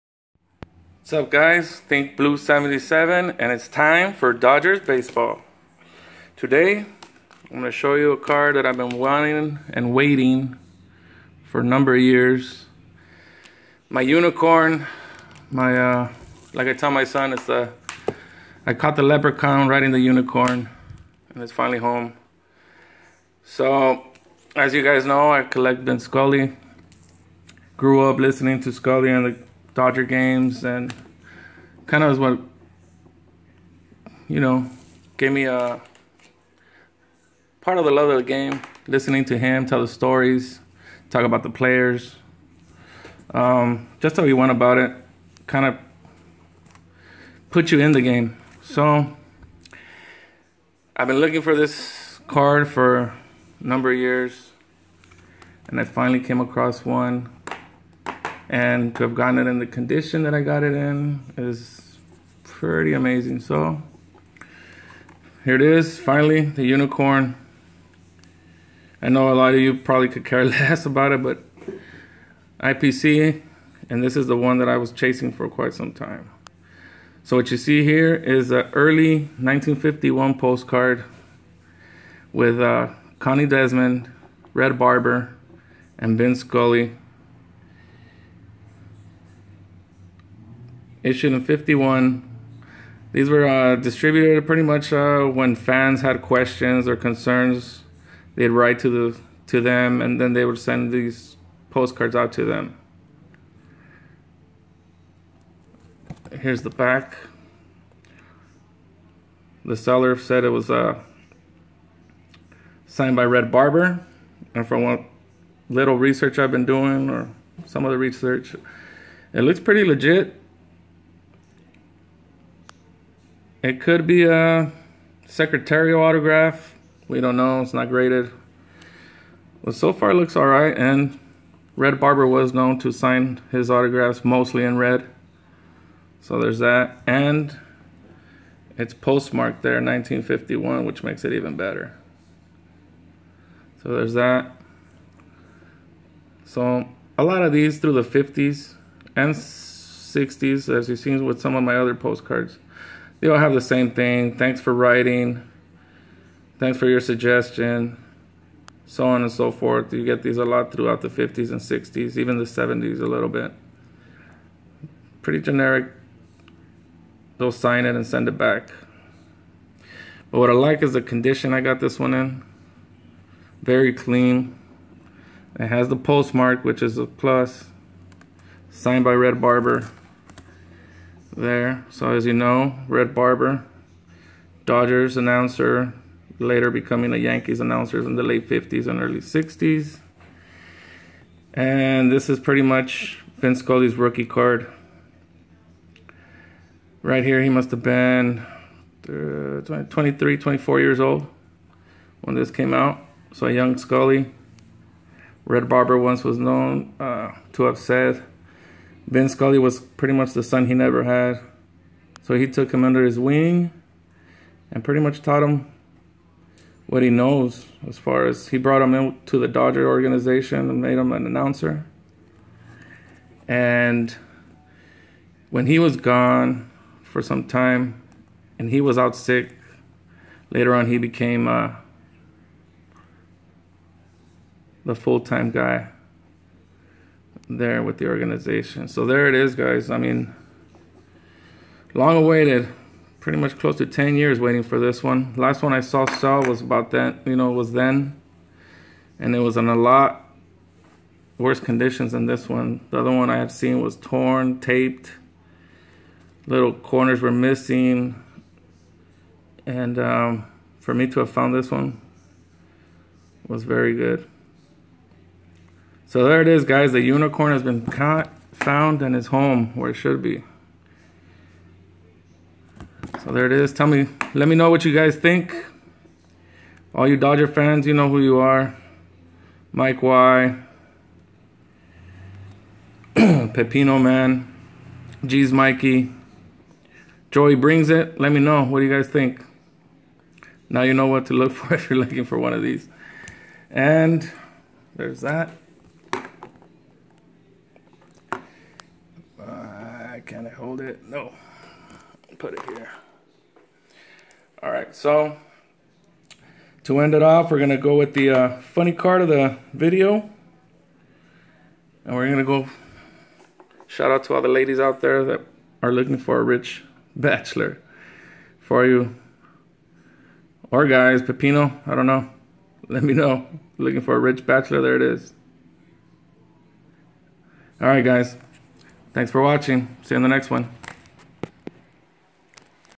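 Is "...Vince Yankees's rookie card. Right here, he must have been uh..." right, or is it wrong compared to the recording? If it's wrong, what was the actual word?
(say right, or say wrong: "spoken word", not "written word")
wrong: "Scully", not "Yankees".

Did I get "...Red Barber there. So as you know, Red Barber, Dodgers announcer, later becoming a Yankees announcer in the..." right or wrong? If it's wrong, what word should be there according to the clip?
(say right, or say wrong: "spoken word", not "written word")
right.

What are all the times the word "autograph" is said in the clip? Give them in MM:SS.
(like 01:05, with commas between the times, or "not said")
02:06, 02:13.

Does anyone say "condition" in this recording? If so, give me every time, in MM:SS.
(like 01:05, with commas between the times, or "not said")
00:59, 02:51, 04:11.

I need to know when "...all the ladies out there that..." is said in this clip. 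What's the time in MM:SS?
05:14.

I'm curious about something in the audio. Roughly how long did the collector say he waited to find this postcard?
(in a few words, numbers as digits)
10 years.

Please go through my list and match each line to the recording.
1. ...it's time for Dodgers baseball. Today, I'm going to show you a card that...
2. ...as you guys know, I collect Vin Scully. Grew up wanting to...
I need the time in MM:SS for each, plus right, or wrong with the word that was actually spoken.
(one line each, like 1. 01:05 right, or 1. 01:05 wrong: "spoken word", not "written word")
1. 00:03 right
2. 00:24 wrong: "listening", not "wanting".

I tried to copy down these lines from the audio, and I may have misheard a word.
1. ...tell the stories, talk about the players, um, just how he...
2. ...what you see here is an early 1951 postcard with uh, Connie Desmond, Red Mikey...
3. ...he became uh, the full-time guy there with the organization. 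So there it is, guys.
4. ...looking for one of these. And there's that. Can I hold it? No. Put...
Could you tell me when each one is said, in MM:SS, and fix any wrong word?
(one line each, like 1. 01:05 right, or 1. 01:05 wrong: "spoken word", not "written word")
1. 00:39 right
2. 01:17 wrong: "Barber", not "Mikey"
3. 03:50 right
4. 04:51 right.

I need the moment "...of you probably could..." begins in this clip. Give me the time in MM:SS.
01:09.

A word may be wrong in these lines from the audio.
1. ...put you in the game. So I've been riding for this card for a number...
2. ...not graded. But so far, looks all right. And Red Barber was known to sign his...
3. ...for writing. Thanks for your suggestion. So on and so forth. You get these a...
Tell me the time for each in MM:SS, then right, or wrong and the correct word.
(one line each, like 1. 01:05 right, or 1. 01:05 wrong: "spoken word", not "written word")
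1. 00:47 wrong: "looking", not "riding"
2. 02:07 right
3. 02:34 right.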